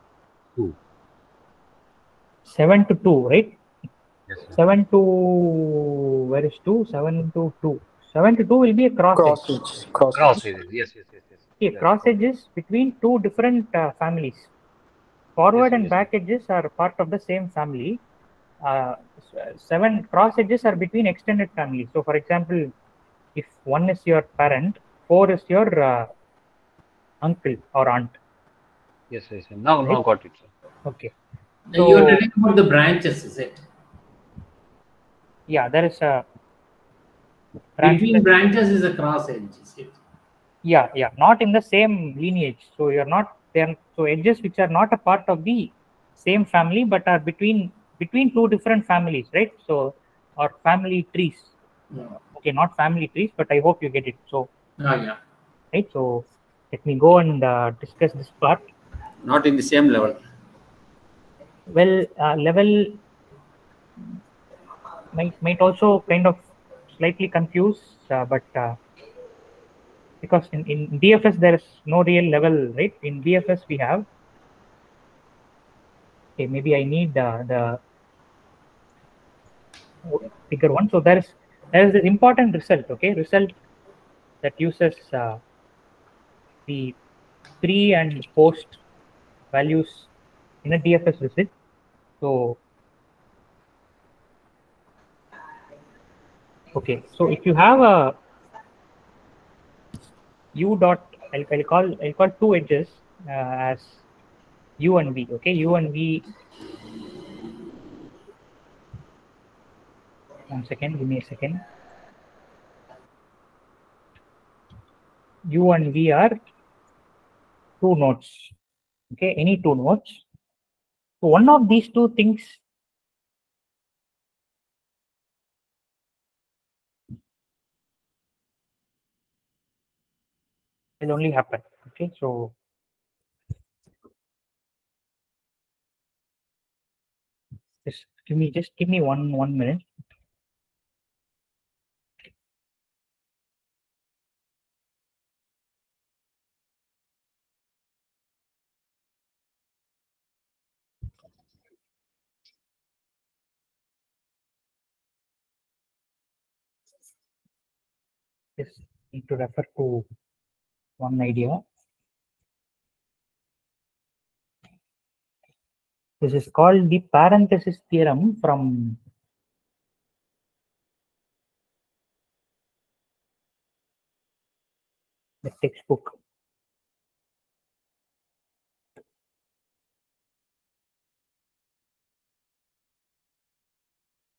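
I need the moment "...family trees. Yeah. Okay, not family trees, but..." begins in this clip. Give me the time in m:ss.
0:50.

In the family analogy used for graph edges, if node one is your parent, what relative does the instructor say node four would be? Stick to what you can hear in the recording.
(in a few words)
uncle or aunt.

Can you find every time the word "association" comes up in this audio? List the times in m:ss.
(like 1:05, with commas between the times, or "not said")
not said.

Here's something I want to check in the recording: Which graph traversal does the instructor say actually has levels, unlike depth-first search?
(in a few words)
BFS.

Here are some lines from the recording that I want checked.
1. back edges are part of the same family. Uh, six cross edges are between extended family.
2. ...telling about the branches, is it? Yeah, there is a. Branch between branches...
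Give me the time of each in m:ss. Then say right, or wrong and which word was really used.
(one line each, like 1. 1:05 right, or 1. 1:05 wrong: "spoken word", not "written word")
1. 0:15 wrong: "seven", not "six"
2. 0:32 right.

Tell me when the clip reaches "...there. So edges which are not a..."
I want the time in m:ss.
0:43.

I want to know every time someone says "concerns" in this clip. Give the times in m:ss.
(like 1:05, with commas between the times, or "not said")
not said.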